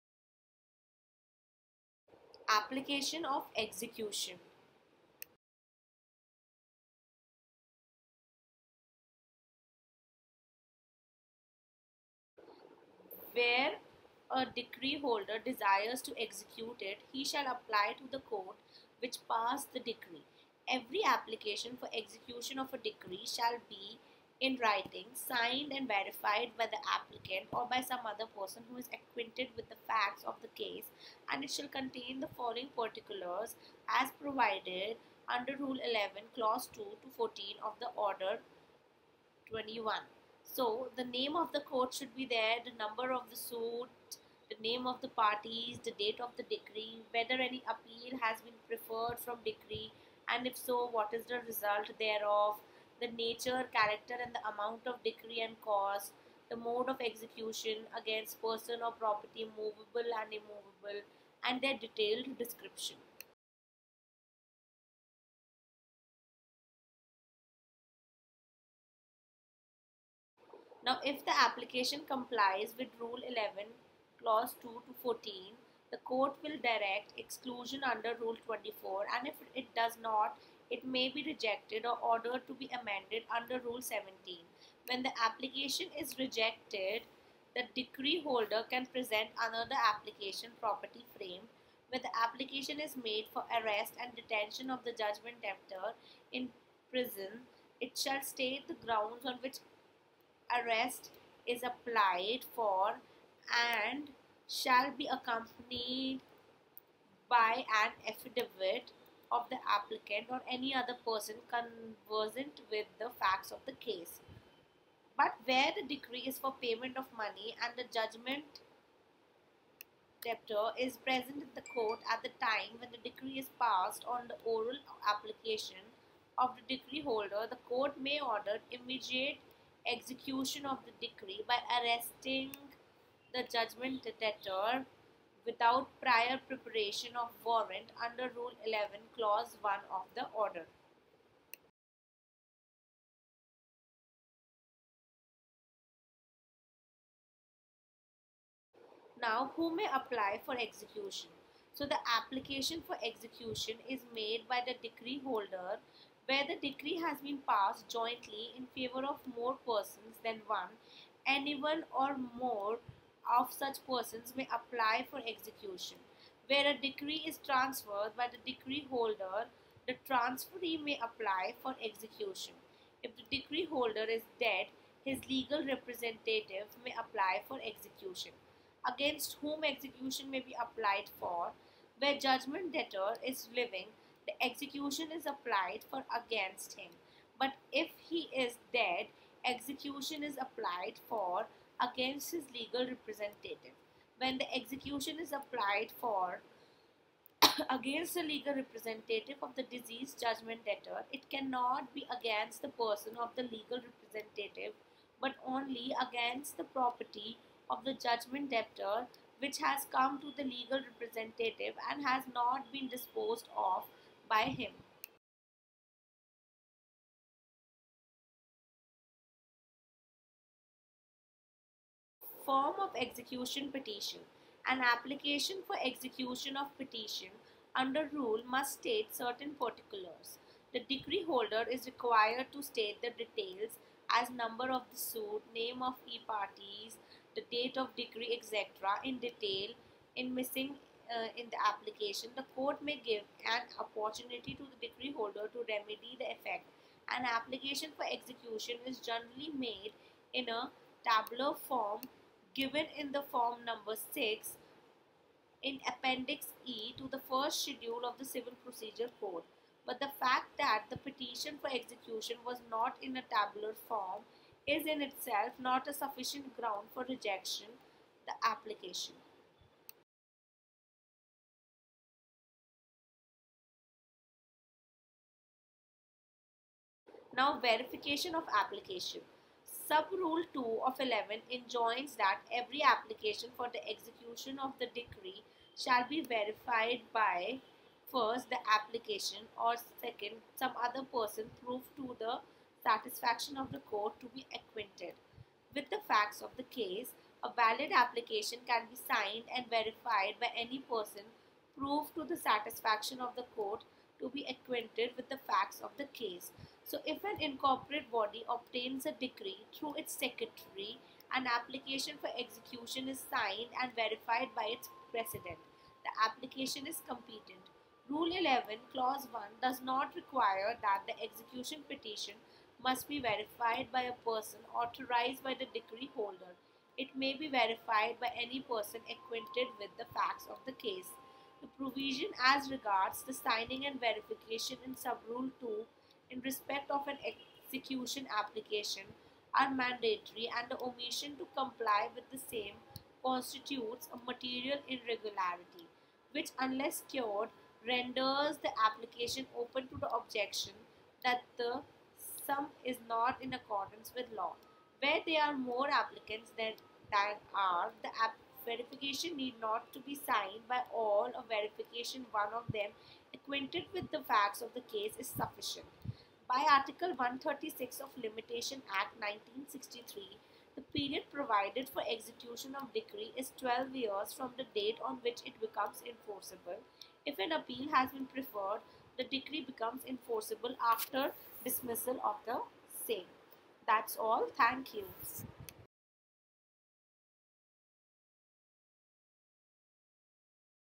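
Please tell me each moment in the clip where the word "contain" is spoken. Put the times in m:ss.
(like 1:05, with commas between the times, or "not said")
0:31.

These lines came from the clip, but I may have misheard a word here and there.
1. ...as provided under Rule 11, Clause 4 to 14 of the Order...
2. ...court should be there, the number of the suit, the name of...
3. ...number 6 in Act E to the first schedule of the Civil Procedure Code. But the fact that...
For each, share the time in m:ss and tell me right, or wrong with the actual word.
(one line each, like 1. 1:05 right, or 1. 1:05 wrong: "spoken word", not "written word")
1. 0:33 wrong: "2", not "4"
2. 0:41 right
3. 4:13 wrong: "Appendix", not "Act".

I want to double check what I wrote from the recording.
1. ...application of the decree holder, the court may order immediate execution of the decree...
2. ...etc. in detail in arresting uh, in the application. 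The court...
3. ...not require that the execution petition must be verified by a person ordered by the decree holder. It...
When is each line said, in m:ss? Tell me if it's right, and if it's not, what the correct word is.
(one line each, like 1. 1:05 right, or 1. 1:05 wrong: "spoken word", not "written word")
1. 2:05 right
2. 3:58 wrong: "missing", not "arresting"
3. 5:19 wrong: "authorized", not "ordered".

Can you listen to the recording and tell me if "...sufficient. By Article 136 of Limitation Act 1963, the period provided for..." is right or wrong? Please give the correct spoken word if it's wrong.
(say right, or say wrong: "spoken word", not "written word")
right.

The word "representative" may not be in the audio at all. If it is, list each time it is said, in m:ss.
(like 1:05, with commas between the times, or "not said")
2:55, 3:12, 3:18, 3:23, 3:30.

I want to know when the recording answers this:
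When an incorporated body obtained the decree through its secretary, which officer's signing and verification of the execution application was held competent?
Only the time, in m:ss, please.
5:14.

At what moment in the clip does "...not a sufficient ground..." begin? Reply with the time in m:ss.
4:25.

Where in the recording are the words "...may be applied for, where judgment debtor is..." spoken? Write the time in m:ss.
3:00.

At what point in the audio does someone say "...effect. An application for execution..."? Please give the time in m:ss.
4:06.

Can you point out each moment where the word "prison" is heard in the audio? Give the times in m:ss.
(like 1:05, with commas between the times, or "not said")
1:36.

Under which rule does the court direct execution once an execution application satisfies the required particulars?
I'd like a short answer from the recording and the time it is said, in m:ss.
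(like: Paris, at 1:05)
Rule 24, at 1:18.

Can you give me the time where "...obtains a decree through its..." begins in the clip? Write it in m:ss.
5:08.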